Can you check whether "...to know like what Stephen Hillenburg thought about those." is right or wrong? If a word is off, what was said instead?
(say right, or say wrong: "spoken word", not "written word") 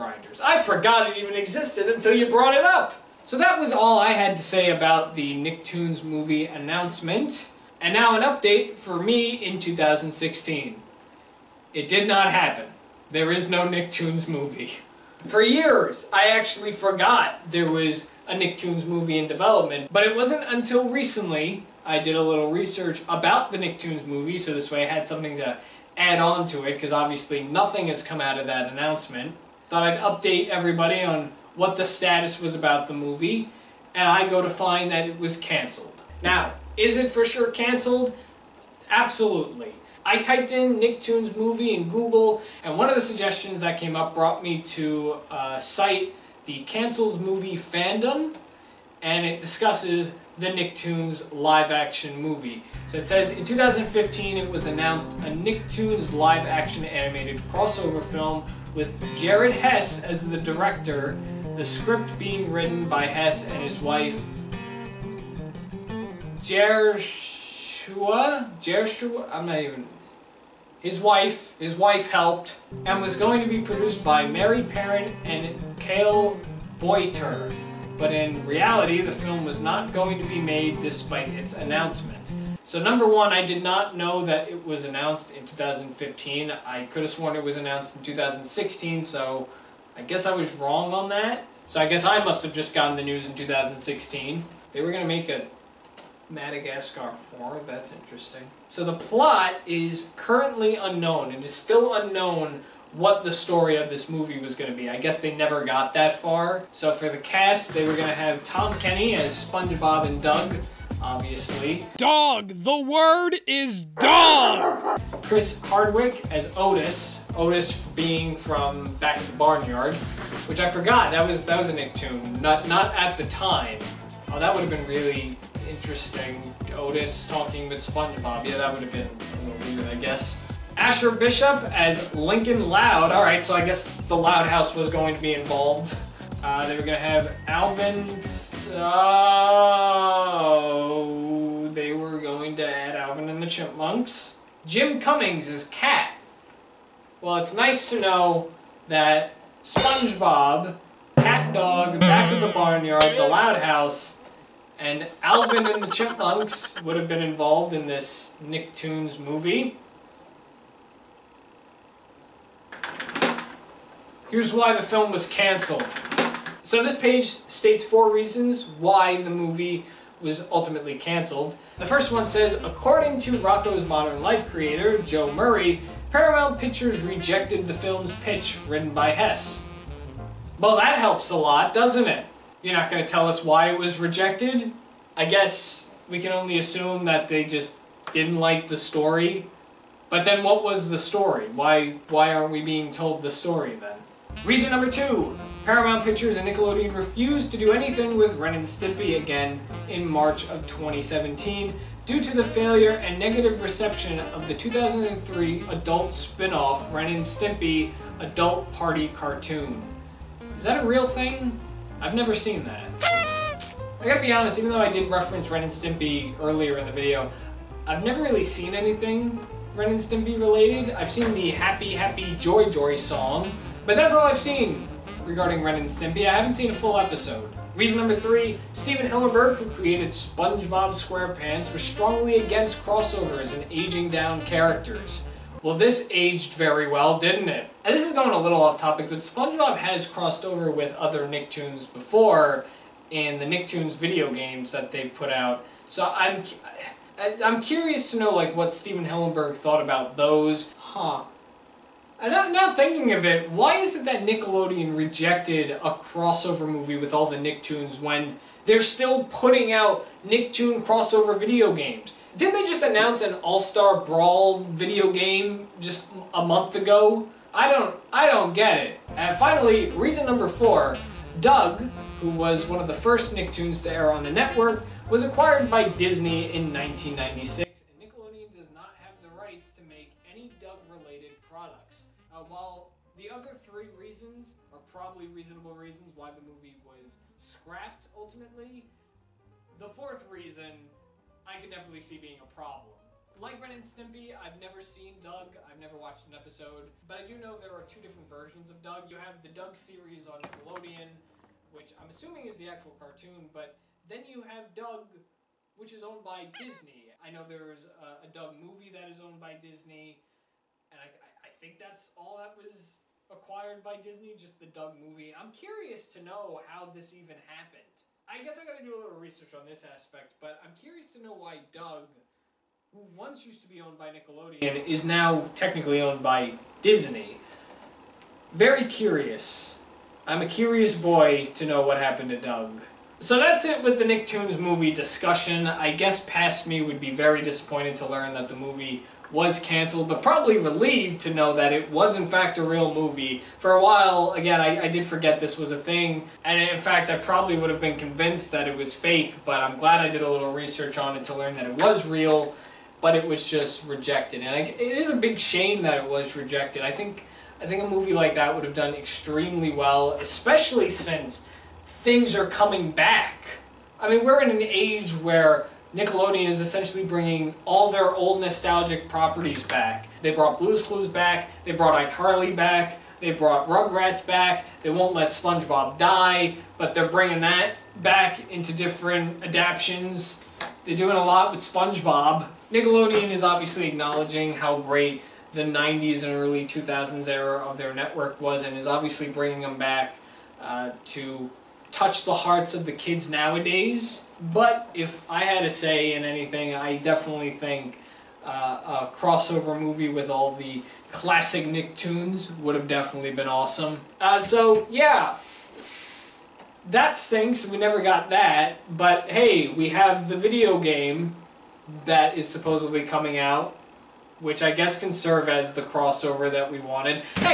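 right.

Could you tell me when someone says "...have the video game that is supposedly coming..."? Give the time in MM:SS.
06:49.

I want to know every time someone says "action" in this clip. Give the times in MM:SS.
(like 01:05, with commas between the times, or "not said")
00:51, 00:56.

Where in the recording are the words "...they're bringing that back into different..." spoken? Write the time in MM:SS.
06:16.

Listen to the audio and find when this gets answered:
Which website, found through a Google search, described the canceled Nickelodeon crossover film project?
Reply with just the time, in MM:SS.
00:46.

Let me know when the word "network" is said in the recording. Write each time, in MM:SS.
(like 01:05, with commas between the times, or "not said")
04:34, 06:27.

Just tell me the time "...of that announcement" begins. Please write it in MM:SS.
00:28.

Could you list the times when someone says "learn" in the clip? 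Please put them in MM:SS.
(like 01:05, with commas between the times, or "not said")
05:38, 05:51.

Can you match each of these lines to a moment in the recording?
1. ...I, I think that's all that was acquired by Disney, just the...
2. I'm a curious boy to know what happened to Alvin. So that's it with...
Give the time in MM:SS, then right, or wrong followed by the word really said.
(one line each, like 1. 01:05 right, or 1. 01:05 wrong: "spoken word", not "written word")
1. 05:11 right
2. 05:30 wrong: "Doug", not "Alvin".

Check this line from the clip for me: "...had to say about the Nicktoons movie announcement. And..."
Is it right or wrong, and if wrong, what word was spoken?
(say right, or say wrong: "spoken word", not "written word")
right.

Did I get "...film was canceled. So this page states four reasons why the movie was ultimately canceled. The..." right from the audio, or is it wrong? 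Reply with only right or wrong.
right.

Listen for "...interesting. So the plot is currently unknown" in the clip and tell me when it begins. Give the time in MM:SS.
01:37.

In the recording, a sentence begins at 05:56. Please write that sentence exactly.
I think, I think a movie like that would have done extremely well, especially since things are coming back.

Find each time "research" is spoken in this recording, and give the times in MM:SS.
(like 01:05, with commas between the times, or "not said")
00:22, 05:19, 05:50.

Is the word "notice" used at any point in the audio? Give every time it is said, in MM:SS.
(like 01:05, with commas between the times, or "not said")
not said.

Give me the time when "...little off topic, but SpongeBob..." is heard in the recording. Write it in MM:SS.
03:58.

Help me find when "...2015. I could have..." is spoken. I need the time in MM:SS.
01:25.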